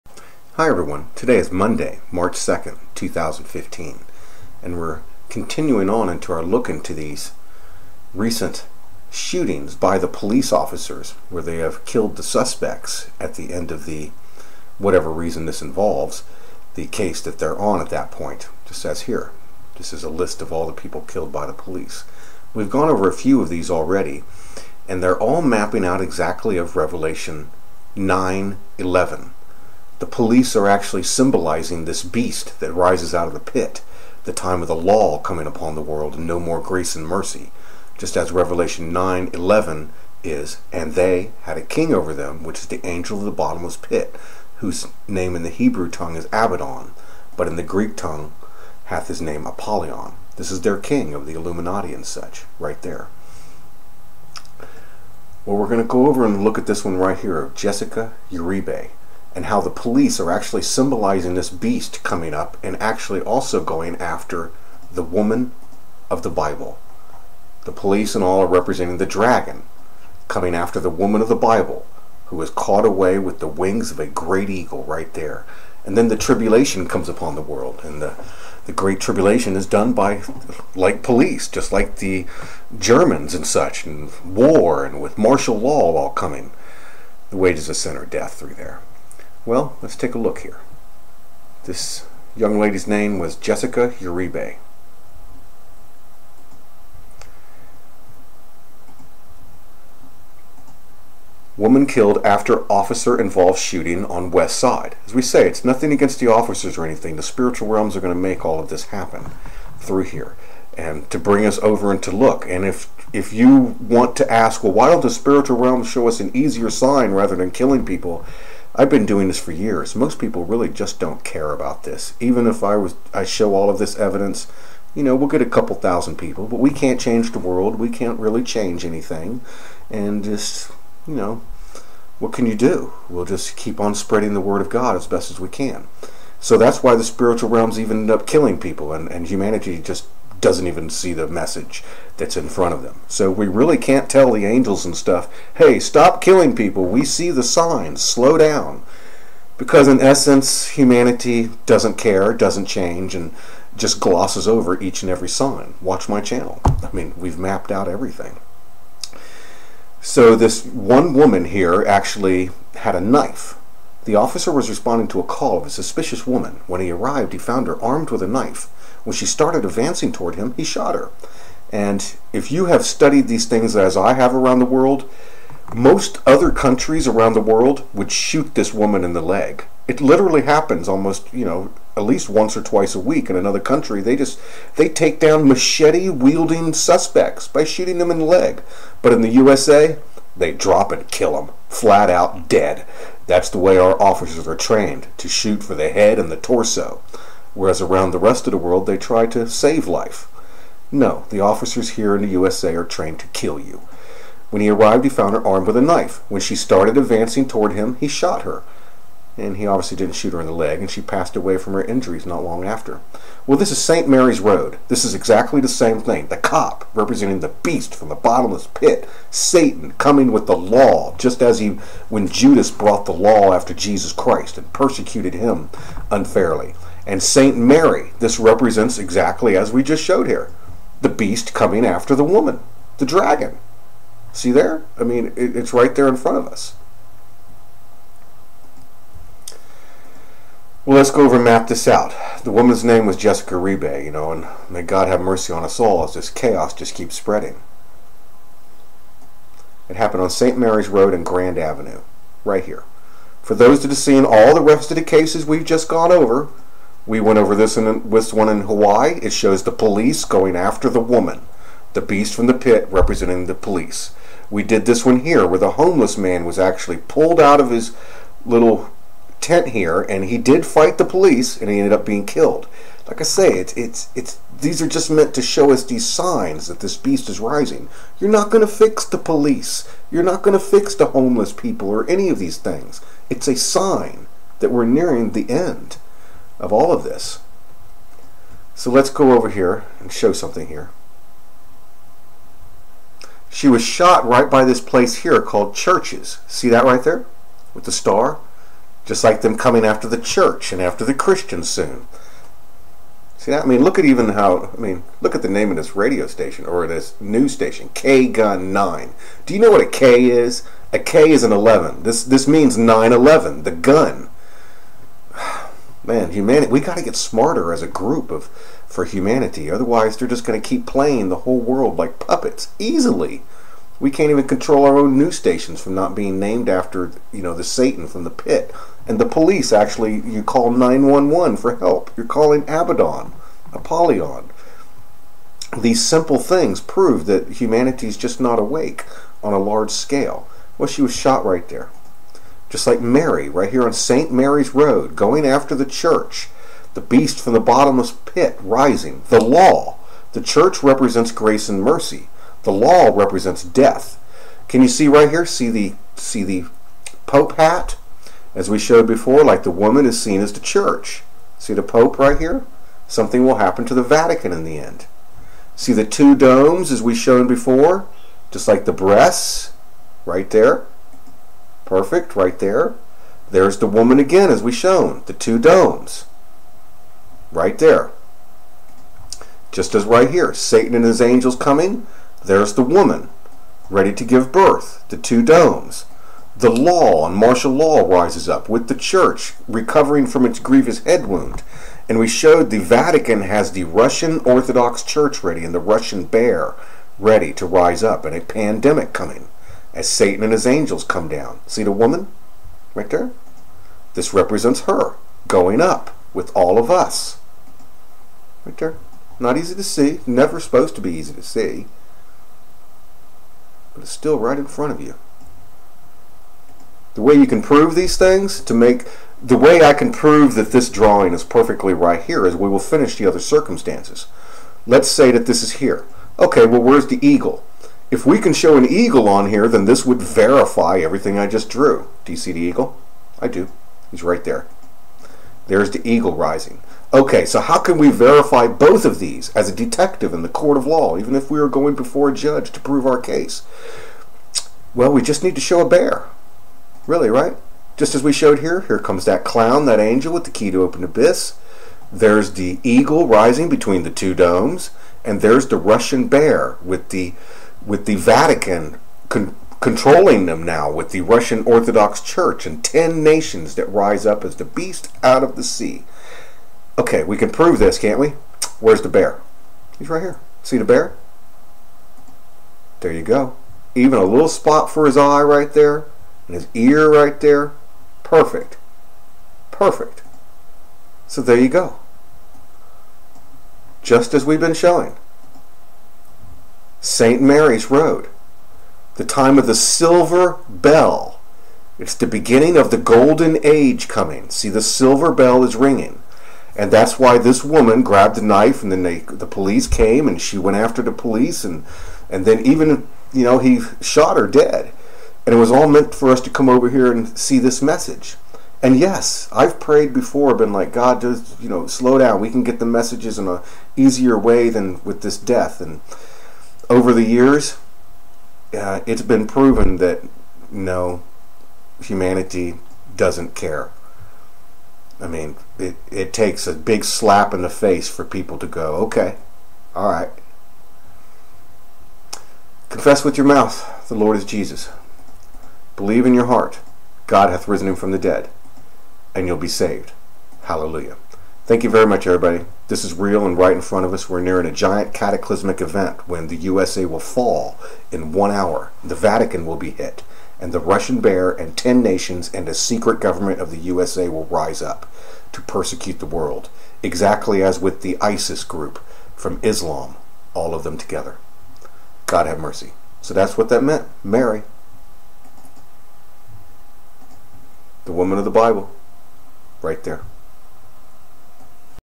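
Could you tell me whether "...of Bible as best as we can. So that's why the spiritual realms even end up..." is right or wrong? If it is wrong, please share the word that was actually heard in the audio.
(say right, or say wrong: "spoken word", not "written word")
wrong: "God", not "Bible".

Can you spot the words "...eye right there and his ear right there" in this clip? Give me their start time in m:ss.
7:55.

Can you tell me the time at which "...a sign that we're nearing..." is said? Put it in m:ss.
4:43.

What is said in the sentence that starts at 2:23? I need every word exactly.
So we really can't tell the angels and stuff, hey, stop killing people.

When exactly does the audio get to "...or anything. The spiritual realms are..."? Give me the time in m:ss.
1:46.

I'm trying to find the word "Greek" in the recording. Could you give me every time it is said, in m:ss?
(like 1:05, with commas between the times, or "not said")
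0:47.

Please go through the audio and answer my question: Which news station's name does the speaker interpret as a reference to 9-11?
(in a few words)
K-Gun 9.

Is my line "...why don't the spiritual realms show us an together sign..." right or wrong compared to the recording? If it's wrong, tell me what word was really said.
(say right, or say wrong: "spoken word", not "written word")
wrong: "easier", not "together".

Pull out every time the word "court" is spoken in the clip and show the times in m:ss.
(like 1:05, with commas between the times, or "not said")
7:20.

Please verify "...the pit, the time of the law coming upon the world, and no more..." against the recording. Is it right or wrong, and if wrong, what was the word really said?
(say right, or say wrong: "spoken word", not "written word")
right.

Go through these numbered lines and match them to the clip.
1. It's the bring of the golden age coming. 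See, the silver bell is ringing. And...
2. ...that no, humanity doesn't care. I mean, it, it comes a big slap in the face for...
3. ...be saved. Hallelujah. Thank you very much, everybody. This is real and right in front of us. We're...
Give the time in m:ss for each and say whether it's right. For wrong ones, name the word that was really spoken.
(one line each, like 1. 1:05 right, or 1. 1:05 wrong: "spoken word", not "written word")
1. 8:11 wrong: "beginning", not "bring"
2. 8:39 wrong: "takes", not "comes"
3. 8:59 right.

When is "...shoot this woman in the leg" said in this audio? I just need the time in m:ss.
2:58.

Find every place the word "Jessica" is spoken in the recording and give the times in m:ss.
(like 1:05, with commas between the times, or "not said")
0:57, 1:33, 4:03.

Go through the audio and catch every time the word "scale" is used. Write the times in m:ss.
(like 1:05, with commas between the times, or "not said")
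5:39.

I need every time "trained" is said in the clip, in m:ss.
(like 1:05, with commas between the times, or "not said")
3:14, 3:22.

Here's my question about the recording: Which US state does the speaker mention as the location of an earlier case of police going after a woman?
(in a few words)
Hawaii.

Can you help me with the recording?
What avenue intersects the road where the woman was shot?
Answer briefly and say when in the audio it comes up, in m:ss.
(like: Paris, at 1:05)
Grand Avenue, at 4:11.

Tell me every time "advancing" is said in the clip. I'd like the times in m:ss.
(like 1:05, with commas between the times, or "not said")
2:49, 3:26.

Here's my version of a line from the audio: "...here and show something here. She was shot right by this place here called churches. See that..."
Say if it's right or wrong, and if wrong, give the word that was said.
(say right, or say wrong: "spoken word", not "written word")
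right.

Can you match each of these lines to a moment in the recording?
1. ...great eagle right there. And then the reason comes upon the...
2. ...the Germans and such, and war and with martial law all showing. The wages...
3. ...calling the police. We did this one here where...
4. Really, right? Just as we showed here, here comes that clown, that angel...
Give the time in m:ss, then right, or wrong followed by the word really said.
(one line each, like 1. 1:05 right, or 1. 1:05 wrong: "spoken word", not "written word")
1. 1:14 wrong: "tribulation", not "reason"
2. 1:21 wrong: "coming", not "showing"
3. 4:22 wrong: "representing", not "calling"
4. 7:27 right.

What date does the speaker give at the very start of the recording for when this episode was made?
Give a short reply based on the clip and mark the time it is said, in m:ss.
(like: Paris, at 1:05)
March 2nd, 2015, at 0:02.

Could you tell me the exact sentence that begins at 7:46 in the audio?
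Okay, we can prove this, can't we?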